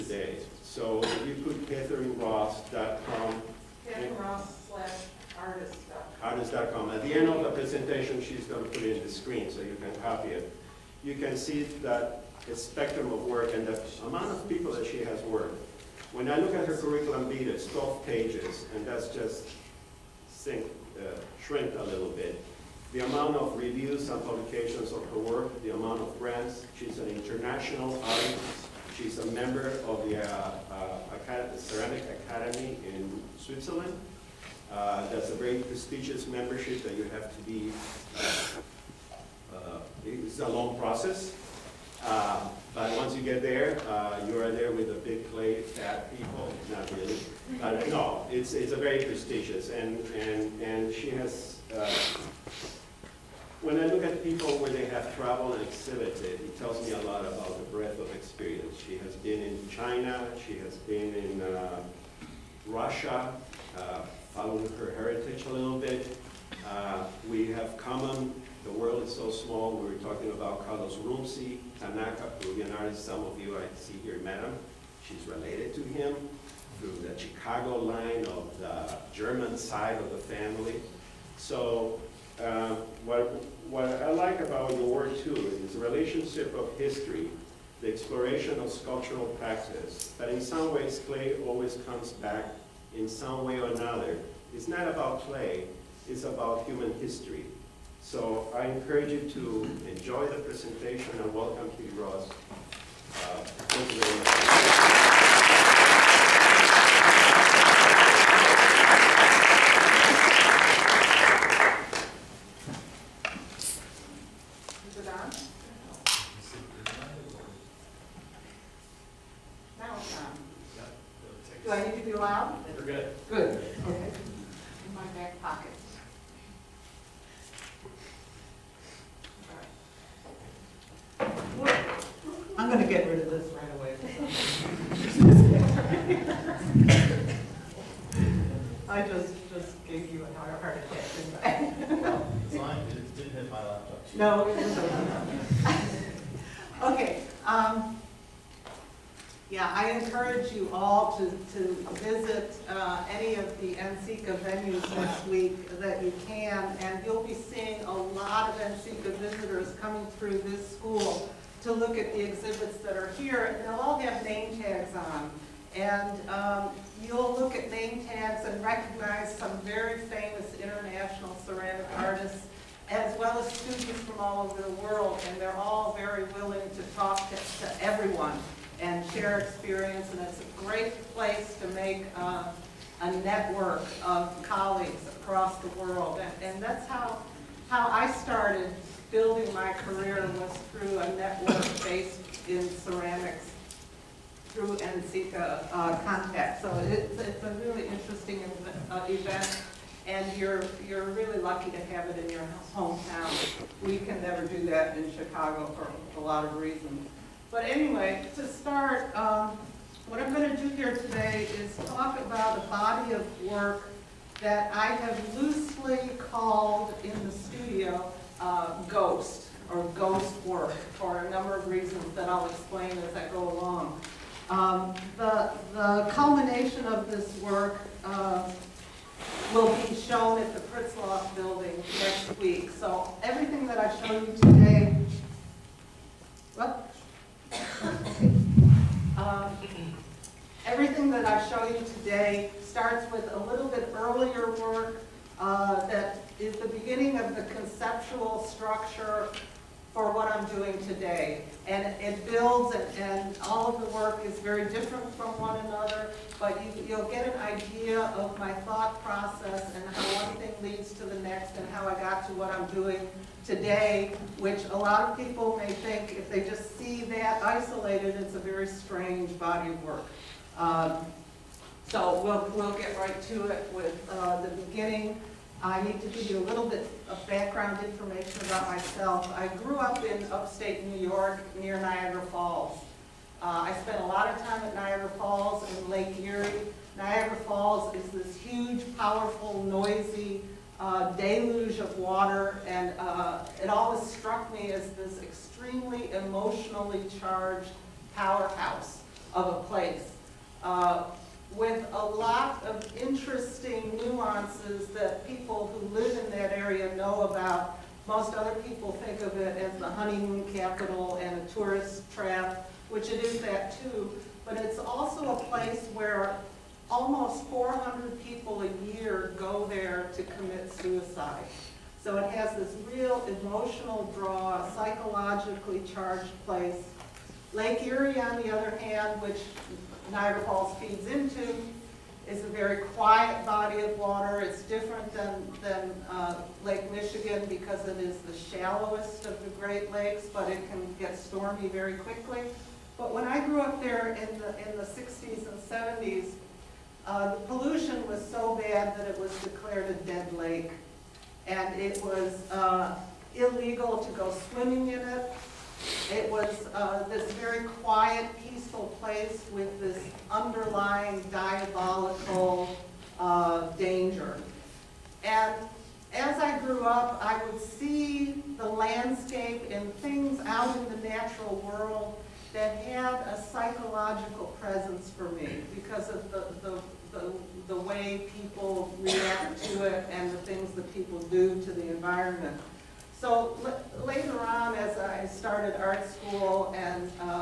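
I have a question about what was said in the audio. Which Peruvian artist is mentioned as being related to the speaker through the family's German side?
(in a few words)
Carlos Runcie Tanaka.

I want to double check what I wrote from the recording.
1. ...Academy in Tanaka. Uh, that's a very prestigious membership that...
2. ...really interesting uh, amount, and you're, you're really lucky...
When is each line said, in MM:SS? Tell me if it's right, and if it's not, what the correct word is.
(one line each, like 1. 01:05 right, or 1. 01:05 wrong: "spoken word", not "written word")
1. 00:32 wrong: "Switzerland", not "Tanaka"
2. 03:17 wrong: "event", not "amount".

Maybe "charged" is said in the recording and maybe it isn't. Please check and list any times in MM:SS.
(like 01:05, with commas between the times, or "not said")
04:57, 05:25.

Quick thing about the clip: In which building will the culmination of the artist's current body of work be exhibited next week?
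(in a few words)
Pritzlaff building.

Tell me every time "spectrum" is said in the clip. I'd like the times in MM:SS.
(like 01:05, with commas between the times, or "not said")
00:12.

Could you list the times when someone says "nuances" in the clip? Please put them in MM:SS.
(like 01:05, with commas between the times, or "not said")
05:03.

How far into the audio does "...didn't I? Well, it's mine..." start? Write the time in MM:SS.
02:21.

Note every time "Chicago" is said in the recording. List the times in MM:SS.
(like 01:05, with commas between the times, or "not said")
01:17, 03:25.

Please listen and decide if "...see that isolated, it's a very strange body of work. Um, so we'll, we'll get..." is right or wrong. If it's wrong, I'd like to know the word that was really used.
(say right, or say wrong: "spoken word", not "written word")
right.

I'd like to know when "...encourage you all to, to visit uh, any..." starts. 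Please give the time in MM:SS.
02:29.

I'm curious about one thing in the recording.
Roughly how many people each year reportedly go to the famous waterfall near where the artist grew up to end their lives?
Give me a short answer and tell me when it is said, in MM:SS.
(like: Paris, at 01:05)
400, at 05:17.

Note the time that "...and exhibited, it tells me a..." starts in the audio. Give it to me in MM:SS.
00:55.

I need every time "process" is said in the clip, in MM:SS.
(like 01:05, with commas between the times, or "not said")
00:40, 04:19.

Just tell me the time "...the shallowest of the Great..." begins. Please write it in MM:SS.
05:38.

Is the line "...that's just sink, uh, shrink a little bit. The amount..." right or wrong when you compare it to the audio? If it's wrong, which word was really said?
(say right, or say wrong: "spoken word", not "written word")
right.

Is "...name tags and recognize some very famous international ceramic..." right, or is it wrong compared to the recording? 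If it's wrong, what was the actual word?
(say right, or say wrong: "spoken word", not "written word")
right.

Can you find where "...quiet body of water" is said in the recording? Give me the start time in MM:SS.
05:32.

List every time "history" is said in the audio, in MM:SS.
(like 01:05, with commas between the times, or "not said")
01:26, 01:36.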